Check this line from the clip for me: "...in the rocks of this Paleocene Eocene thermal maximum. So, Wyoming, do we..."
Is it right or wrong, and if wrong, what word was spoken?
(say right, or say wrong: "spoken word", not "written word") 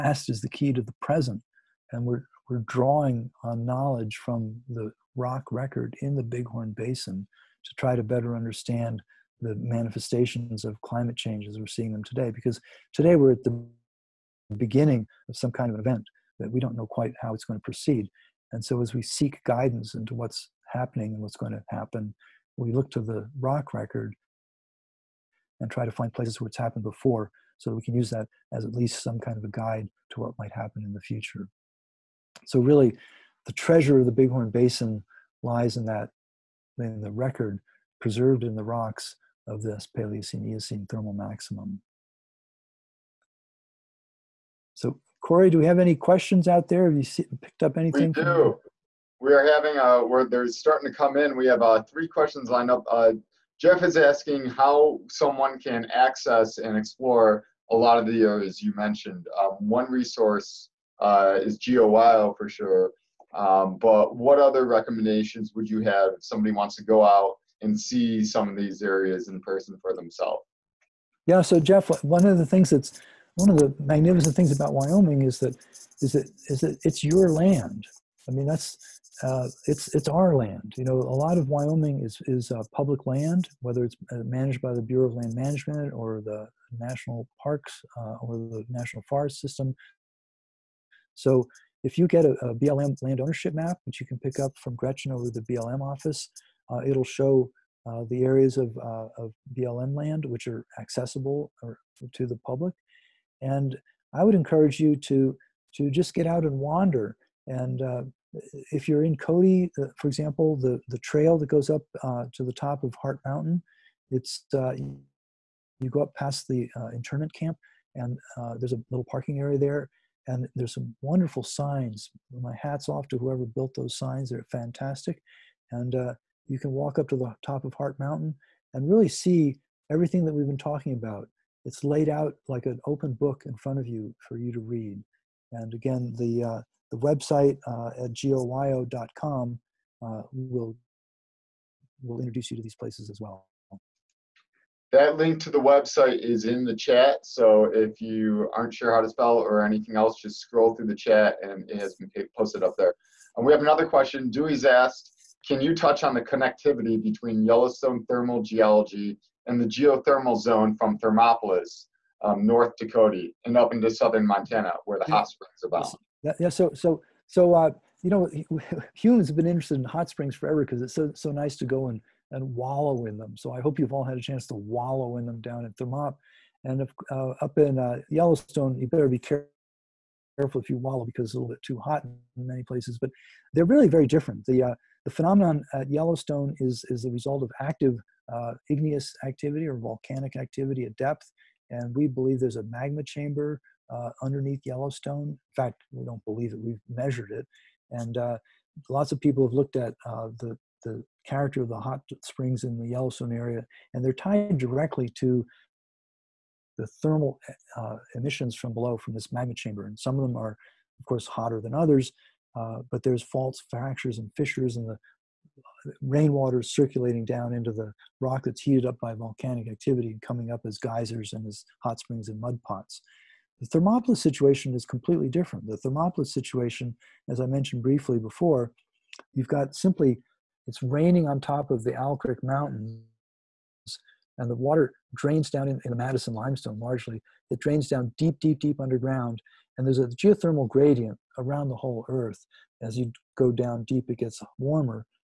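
wrong: "Corey", not "Wyoming".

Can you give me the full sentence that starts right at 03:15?
In fact, we don't believe it, we've measured it.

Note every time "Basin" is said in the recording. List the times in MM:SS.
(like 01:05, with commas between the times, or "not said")
00:06, 00:34.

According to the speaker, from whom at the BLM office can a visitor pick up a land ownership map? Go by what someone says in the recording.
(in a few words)
Gretchen.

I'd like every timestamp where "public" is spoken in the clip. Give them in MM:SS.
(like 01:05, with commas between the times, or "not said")
01:22, 01:42.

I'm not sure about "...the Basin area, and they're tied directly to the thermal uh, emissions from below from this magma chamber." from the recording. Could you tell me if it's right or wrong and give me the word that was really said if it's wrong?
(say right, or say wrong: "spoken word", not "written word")
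wrong: "Yellowstone", not "Basin".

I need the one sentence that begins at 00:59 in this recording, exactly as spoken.
Um, one resource uh, is GeoWyo for sure.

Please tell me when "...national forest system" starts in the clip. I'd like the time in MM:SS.
01:28.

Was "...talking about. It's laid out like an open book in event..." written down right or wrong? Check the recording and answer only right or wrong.
wrong.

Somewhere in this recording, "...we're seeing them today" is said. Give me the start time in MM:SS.
00:11.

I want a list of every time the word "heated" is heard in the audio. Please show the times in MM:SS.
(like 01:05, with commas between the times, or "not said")
03:38.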